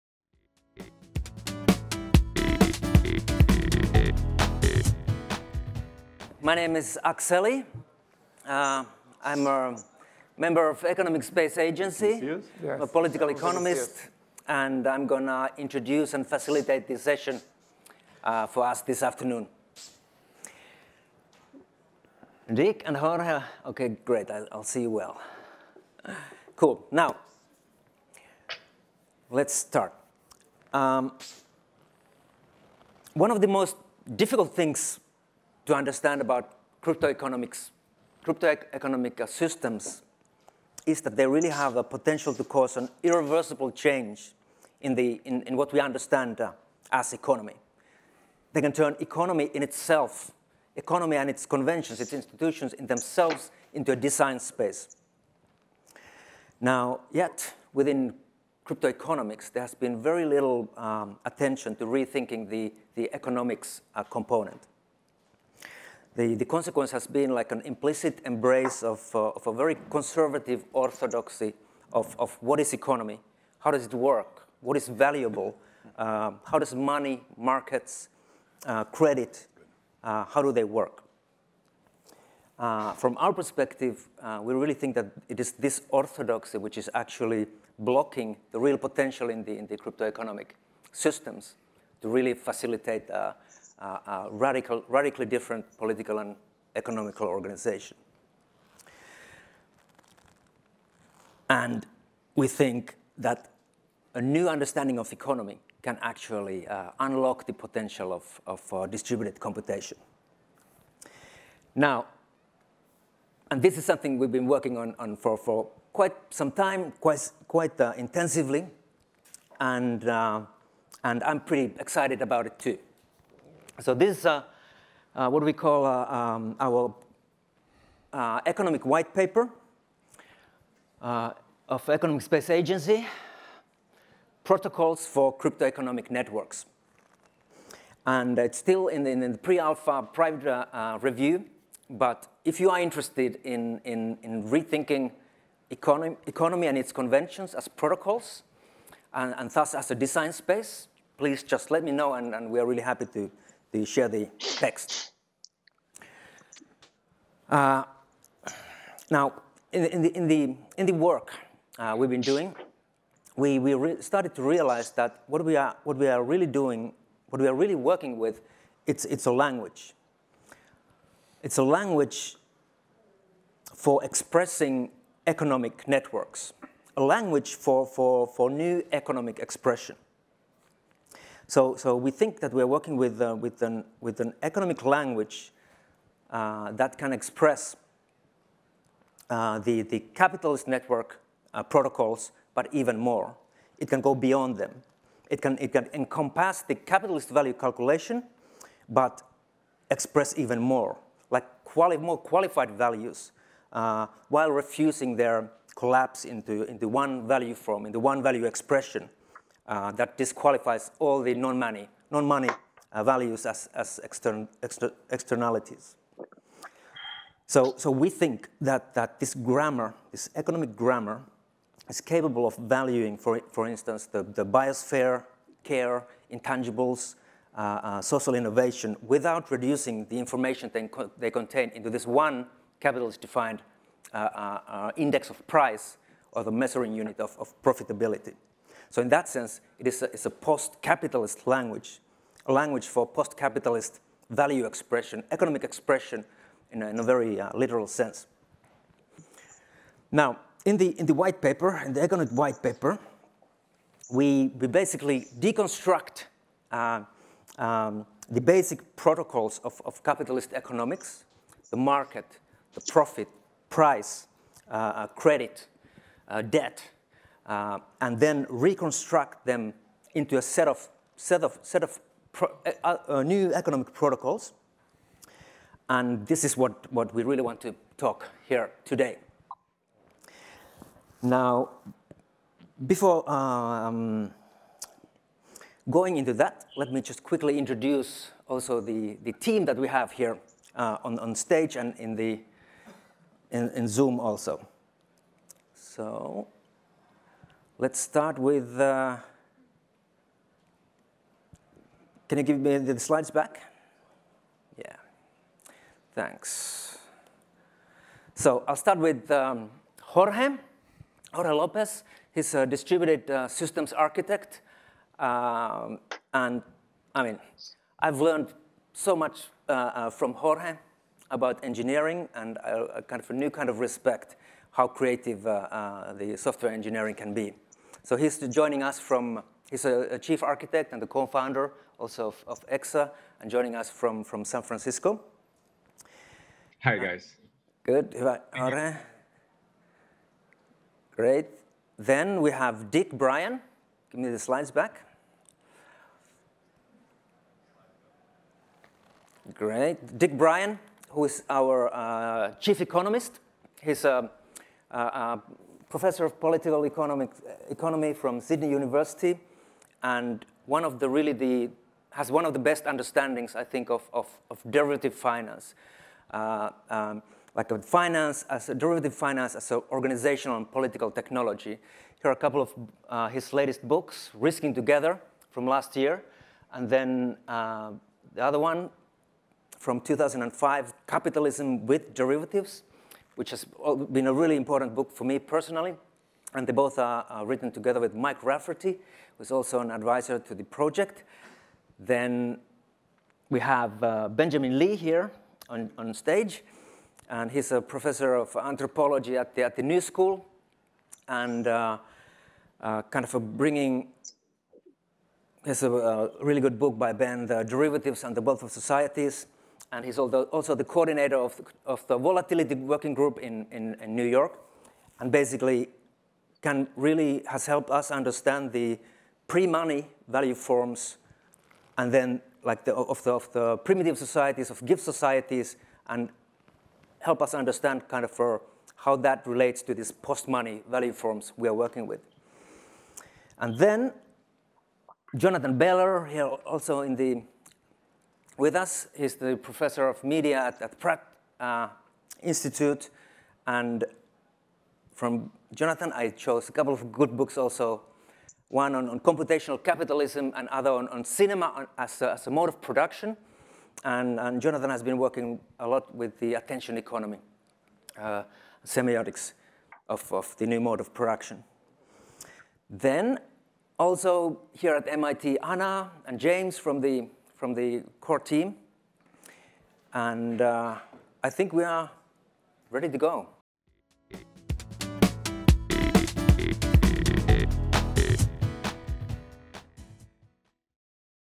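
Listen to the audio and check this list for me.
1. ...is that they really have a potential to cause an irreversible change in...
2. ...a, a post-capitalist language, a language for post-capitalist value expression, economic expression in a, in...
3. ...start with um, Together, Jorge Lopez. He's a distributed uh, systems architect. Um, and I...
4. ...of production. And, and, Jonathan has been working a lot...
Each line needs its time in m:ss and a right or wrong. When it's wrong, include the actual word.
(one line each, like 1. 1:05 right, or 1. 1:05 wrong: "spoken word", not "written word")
1. 0:40 right
2. 4:00 right
3. 5:08 wrong: "Jorge", not "Together"
4. 7:32 right.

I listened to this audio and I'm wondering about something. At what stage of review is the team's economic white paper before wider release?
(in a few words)
pre-alpha private review.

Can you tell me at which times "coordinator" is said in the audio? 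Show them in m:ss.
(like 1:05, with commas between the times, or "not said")
6:50.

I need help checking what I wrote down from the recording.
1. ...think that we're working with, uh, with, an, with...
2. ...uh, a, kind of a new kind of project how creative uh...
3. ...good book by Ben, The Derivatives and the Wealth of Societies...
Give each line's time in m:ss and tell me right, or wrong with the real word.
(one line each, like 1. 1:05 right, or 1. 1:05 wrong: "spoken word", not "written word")
1. 3:02 right
2. 5:22 wrong: "respect", not "project"
3. 6:46 right.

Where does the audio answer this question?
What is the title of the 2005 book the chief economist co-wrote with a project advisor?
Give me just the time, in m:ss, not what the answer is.
6:21.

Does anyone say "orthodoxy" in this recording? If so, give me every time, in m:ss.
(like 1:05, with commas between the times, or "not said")
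1:10, 1:25.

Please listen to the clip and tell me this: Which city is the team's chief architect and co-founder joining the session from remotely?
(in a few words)
San Francisco.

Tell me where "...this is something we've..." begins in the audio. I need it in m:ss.
1:53.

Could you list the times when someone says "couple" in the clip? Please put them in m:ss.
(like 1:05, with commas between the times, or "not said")
6:12, 7:26.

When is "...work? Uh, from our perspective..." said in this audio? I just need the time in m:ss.
1:20.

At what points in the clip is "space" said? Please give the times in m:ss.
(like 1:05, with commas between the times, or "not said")
0:11, 0:54, 2:12, 2:30.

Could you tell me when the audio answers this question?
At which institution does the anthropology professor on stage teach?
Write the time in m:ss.
6:39.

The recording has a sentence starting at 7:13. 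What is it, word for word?
And then Jonathan Beller, here also in the with us.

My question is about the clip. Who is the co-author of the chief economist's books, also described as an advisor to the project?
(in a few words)
Mike Rafferty.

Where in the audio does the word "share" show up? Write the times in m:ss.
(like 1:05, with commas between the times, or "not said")
2:33.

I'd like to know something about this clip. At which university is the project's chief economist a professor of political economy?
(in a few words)
Sydney University.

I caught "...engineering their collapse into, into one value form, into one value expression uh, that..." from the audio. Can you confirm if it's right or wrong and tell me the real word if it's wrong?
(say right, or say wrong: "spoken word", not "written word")
wrong: "refusing", not "engineering".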